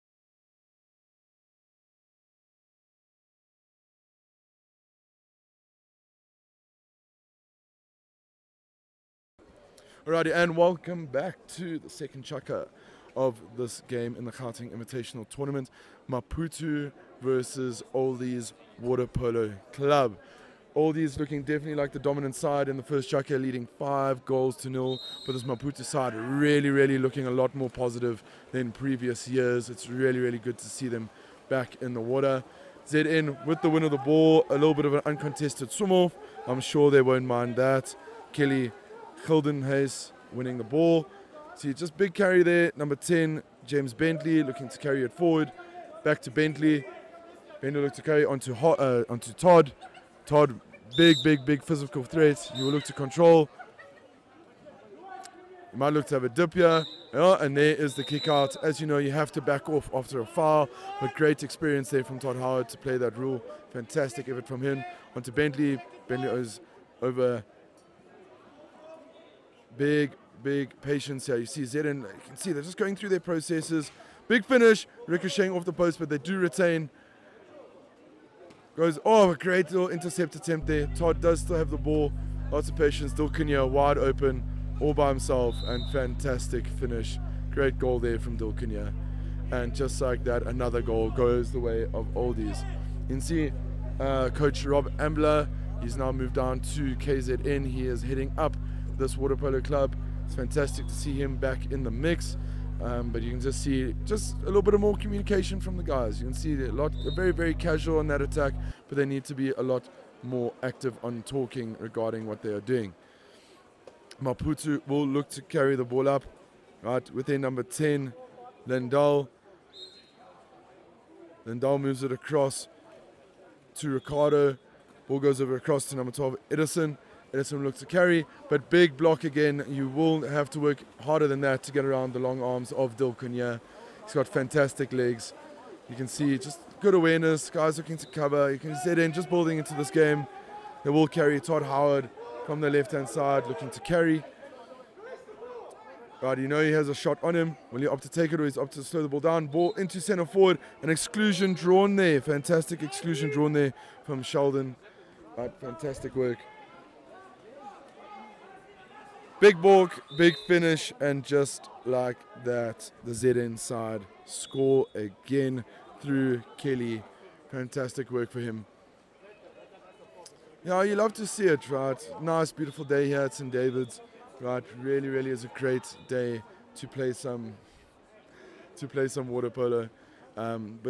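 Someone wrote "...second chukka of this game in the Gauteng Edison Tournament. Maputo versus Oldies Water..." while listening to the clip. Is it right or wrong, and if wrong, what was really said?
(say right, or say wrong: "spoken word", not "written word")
wrong: "Invitational", not "Edison".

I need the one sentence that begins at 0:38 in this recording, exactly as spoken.
Kelly Hilden Hayes winning the ball.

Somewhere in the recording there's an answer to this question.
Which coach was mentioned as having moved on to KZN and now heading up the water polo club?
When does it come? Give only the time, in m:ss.
1:34.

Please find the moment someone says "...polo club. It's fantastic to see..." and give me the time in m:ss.
1:39.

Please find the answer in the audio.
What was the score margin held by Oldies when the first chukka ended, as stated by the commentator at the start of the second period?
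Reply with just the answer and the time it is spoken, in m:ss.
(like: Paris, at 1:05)
5 goals to nil, at 0:23.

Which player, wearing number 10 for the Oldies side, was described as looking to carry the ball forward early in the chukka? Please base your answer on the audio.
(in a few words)
James Bentley.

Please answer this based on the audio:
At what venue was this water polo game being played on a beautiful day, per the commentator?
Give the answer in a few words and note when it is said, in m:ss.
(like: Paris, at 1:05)
St. David's, at 2:53.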